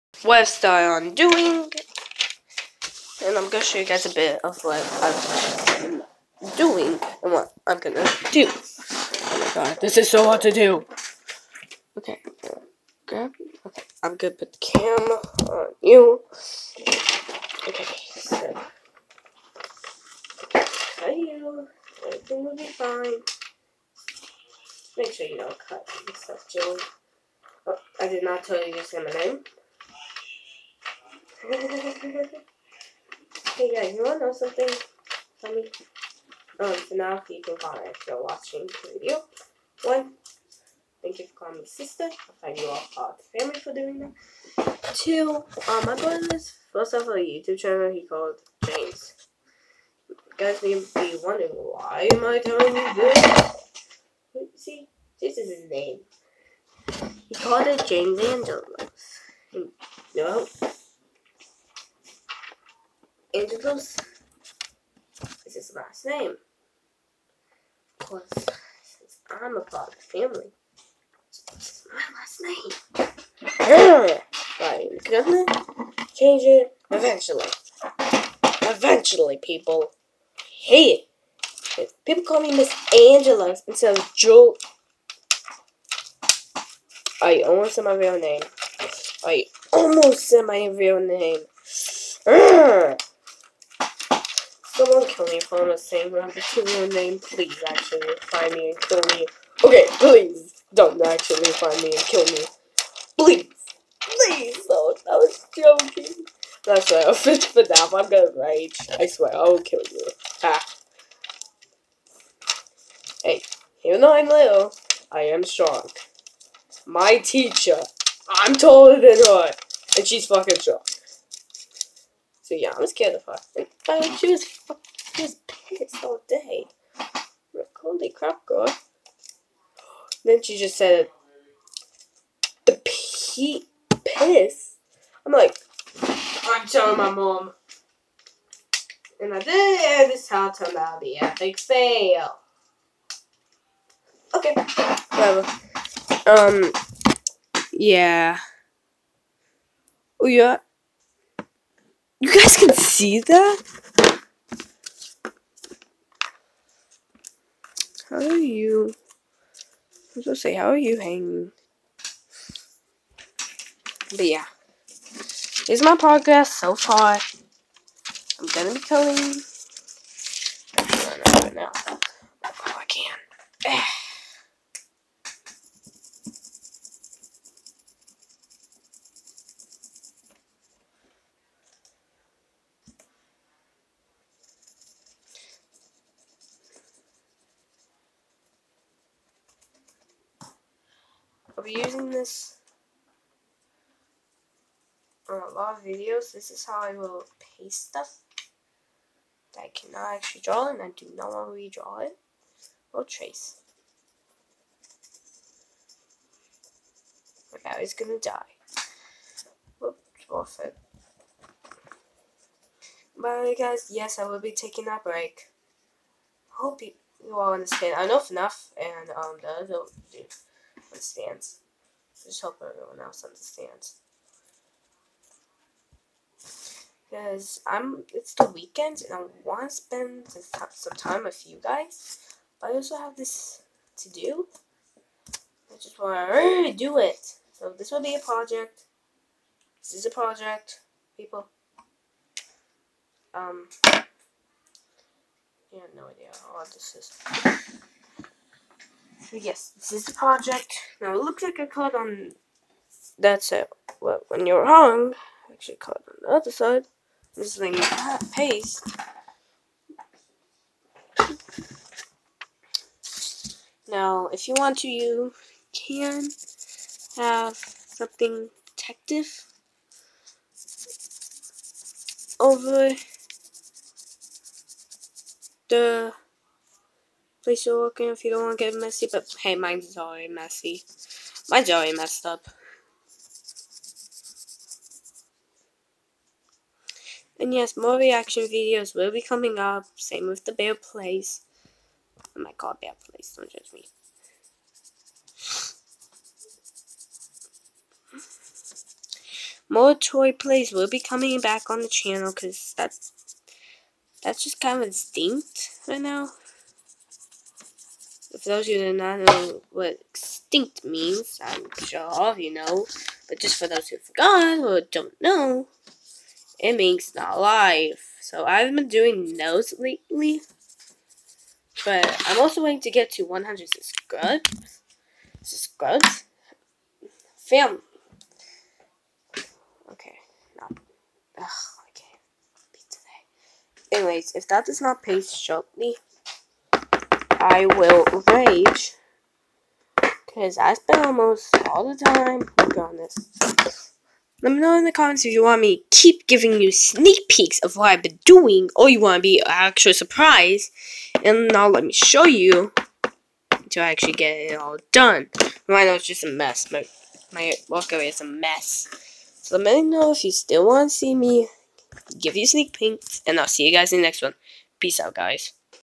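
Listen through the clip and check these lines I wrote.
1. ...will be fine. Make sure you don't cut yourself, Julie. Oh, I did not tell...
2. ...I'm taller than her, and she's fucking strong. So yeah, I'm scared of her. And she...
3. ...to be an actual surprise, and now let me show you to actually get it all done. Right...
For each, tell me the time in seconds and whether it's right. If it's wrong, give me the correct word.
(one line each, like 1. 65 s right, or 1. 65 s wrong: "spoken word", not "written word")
1. 22 s right
2. 118 s right
3. 349 s right.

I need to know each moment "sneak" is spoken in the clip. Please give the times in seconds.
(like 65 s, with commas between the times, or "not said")
346 s, 362 s.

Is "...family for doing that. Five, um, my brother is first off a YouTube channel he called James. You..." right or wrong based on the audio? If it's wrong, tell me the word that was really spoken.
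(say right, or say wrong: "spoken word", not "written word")
wrong: "Two", not "Five".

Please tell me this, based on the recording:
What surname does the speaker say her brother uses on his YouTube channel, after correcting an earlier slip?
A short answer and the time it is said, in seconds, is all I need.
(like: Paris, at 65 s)
Andrews, at 63 s.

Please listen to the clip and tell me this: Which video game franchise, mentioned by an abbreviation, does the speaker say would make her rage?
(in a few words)
FNAF.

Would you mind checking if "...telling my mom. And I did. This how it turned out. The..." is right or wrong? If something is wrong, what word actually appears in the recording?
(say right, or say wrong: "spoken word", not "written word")
right.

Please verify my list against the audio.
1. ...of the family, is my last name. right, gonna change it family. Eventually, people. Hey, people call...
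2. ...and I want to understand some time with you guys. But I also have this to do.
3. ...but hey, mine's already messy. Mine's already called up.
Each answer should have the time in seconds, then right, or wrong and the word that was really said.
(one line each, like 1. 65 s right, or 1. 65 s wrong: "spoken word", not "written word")
1. 69 s wrong: "eventually", not "family"
2. 229 s wrong: "spend", not "understand"
3. 279 s wrong: "messed", not "called".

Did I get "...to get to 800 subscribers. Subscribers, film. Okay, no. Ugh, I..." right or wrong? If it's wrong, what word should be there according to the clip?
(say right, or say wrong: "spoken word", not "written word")
wrong: "100", not "800".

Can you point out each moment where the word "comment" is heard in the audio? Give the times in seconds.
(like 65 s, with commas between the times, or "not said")
37 s, 344 s.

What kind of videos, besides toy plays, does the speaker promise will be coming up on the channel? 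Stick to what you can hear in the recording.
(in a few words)
reaction videos.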